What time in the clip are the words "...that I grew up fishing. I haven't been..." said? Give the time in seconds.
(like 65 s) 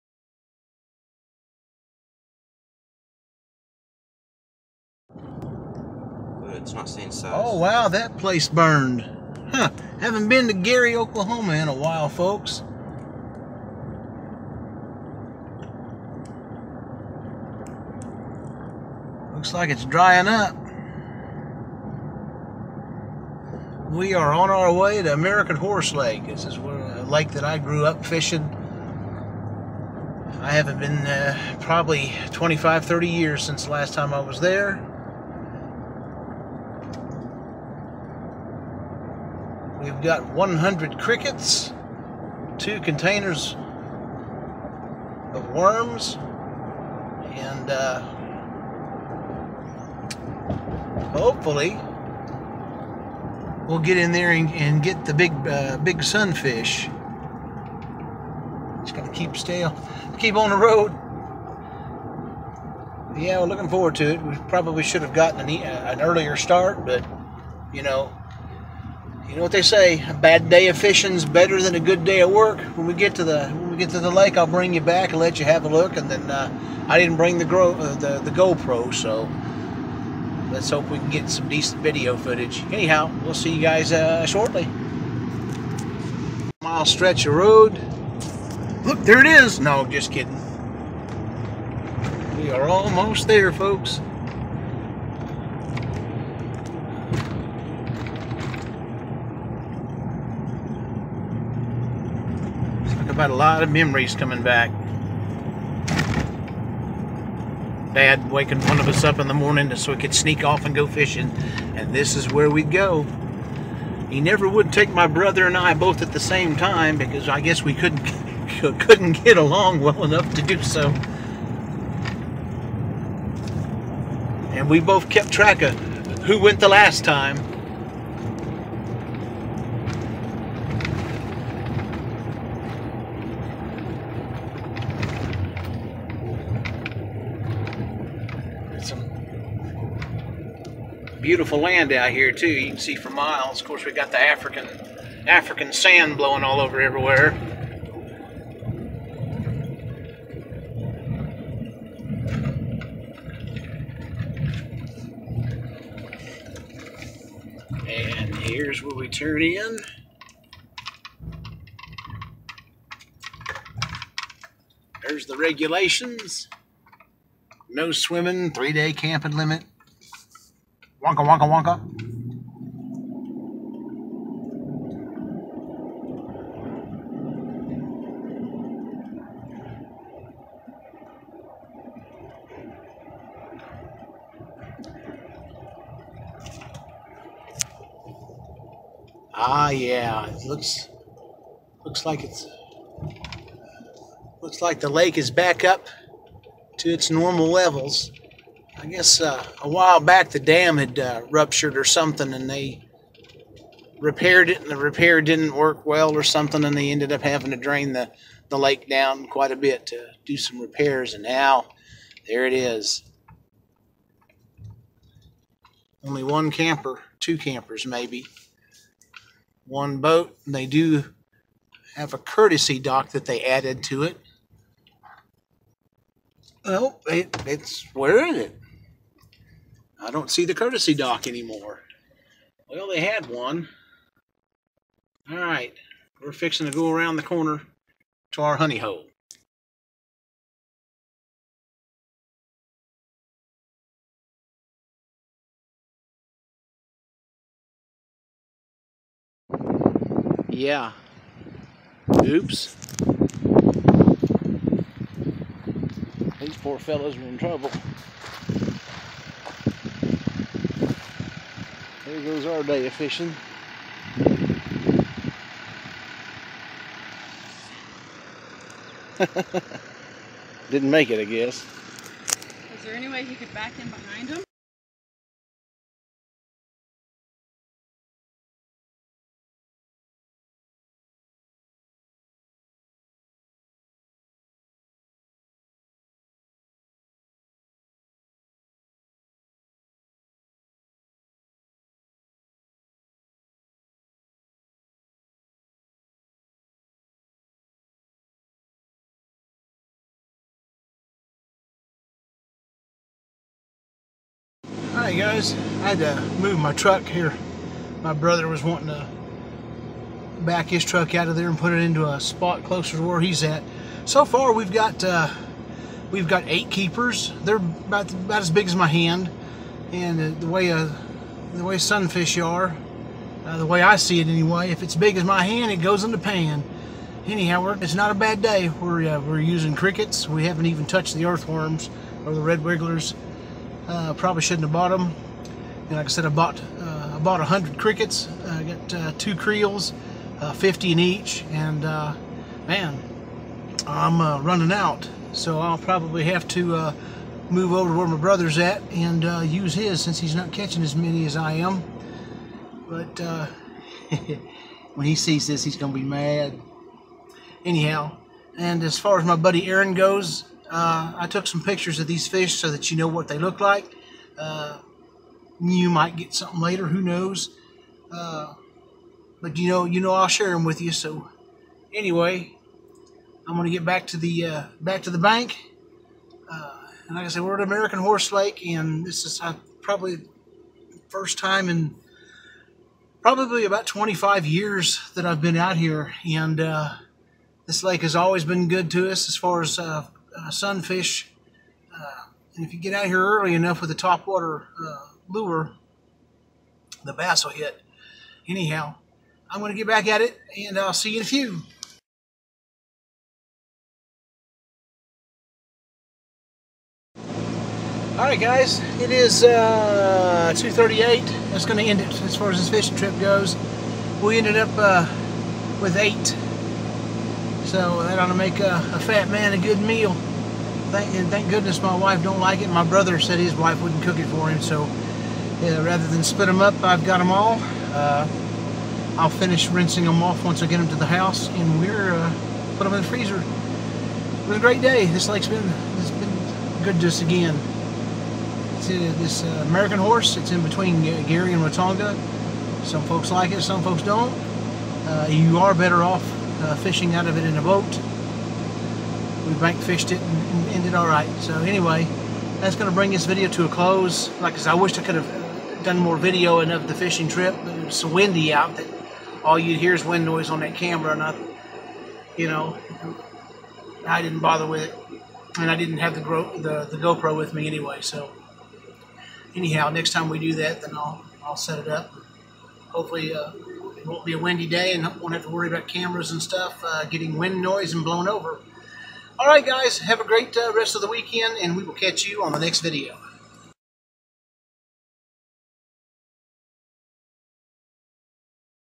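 27 s.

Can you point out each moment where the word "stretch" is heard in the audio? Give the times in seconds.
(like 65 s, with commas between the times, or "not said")
86 s.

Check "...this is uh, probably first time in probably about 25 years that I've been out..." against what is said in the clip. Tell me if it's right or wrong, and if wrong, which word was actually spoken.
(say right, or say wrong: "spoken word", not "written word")
right.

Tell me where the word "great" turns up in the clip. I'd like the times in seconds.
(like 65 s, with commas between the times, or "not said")
434 s, 480 s.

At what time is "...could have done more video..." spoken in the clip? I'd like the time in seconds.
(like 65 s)
455 s.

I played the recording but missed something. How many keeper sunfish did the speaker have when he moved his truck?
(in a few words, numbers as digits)
8.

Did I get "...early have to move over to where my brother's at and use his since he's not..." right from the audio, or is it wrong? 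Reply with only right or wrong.
wrong.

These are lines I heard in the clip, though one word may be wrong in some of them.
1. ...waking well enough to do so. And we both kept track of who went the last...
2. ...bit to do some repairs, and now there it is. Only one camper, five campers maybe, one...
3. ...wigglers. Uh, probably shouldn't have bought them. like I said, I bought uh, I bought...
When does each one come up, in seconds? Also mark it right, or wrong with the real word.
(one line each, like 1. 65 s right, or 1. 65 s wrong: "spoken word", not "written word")
1. 119 s wrong: "along", not "waking"
2. 209 s wrong: "two", not "five"
3. 332 s right.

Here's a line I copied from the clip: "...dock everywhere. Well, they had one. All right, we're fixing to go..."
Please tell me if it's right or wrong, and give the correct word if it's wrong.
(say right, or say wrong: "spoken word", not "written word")
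wrong: "anymore", not "everywhere".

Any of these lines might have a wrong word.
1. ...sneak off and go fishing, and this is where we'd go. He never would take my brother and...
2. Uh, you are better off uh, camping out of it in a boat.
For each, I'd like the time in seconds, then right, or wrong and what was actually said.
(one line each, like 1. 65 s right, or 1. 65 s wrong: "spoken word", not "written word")
1. 110 s right
2. 445 s wrong: "fishing", not "camping".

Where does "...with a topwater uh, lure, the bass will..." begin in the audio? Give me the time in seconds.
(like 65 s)
393 s.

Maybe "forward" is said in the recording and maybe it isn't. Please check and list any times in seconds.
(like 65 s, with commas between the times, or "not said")
63 s.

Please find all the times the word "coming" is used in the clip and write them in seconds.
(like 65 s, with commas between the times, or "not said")
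104 s.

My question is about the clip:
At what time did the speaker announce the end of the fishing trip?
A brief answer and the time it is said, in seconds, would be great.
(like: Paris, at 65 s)
2:38, at 410 s.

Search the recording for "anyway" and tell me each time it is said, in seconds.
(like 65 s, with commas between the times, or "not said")
324 s, 371 s, 451 s, 467 s.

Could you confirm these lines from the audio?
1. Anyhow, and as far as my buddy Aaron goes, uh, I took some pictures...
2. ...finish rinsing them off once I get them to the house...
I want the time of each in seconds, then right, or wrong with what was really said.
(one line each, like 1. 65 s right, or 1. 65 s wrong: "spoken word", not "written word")
1. 357 s right
2. 429 s right.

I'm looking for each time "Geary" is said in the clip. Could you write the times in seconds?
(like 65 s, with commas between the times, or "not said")
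10 s, 441 s.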